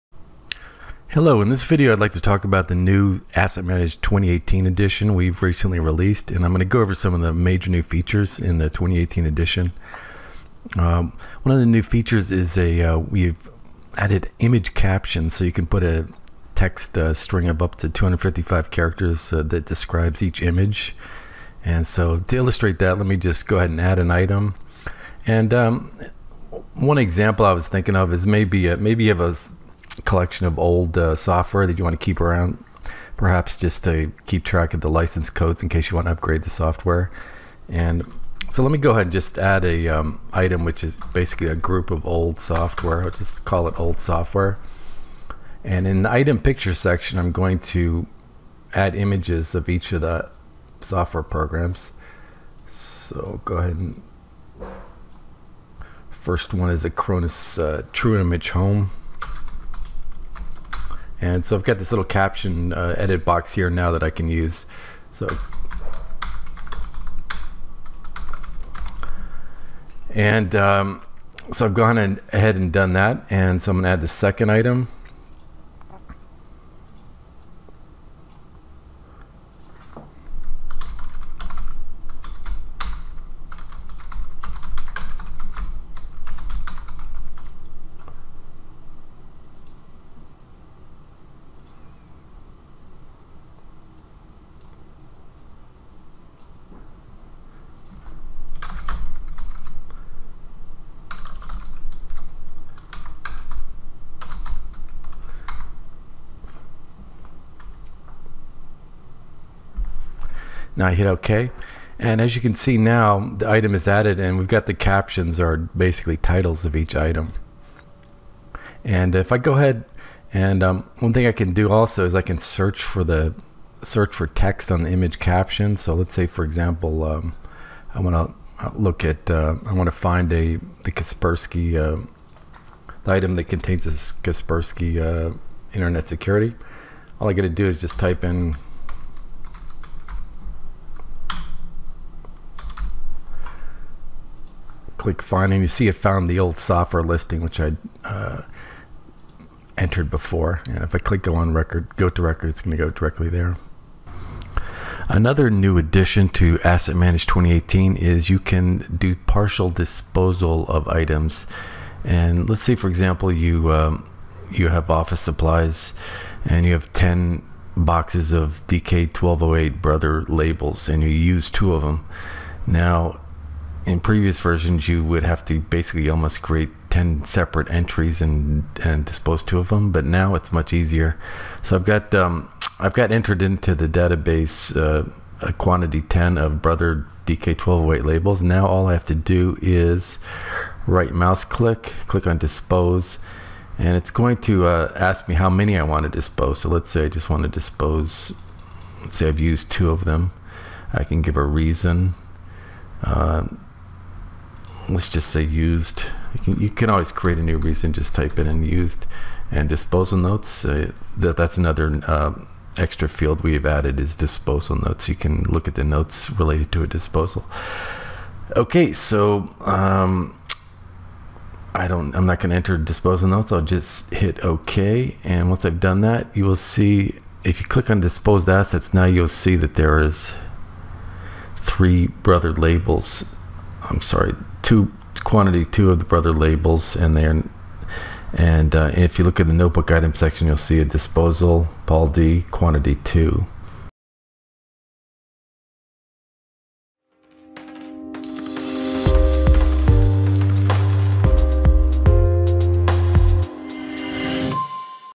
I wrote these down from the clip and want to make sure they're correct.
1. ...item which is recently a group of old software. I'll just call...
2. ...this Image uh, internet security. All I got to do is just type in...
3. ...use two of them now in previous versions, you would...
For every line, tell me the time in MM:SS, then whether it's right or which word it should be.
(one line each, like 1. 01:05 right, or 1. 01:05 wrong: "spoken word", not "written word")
1. 00:40 wrong: "basically", not "recently"
2. 02:13 wrong: "Kaspersky", not "Image"
3. 02:51 right.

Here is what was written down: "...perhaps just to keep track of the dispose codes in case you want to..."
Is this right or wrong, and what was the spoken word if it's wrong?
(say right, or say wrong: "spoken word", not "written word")
wrong: "license", not "dispose".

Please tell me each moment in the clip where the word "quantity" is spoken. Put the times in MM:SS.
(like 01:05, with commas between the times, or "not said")
03:05, 03:55, 04:02.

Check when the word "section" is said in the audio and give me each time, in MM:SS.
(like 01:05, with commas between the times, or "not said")
00:46, 04:00.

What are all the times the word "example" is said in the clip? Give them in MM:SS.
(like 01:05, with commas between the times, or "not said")
00:26, 02:06, 02:42.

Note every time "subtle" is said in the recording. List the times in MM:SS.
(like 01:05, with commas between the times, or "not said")
not said.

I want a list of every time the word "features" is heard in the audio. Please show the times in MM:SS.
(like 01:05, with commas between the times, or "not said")
00:07, 00:11.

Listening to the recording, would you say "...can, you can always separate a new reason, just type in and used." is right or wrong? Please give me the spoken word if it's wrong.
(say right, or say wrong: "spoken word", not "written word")
wrong: "create", not "separate".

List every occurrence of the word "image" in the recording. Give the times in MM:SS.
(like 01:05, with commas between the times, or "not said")
00:14, 00:20, 00:48, 00:58, 02:04.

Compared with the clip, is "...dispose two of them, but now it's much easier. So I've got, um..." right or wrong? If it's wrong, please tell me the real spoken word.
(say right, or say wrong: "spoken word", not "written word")
right.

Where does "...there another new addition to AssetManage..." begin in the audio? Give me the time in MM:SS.
02:33.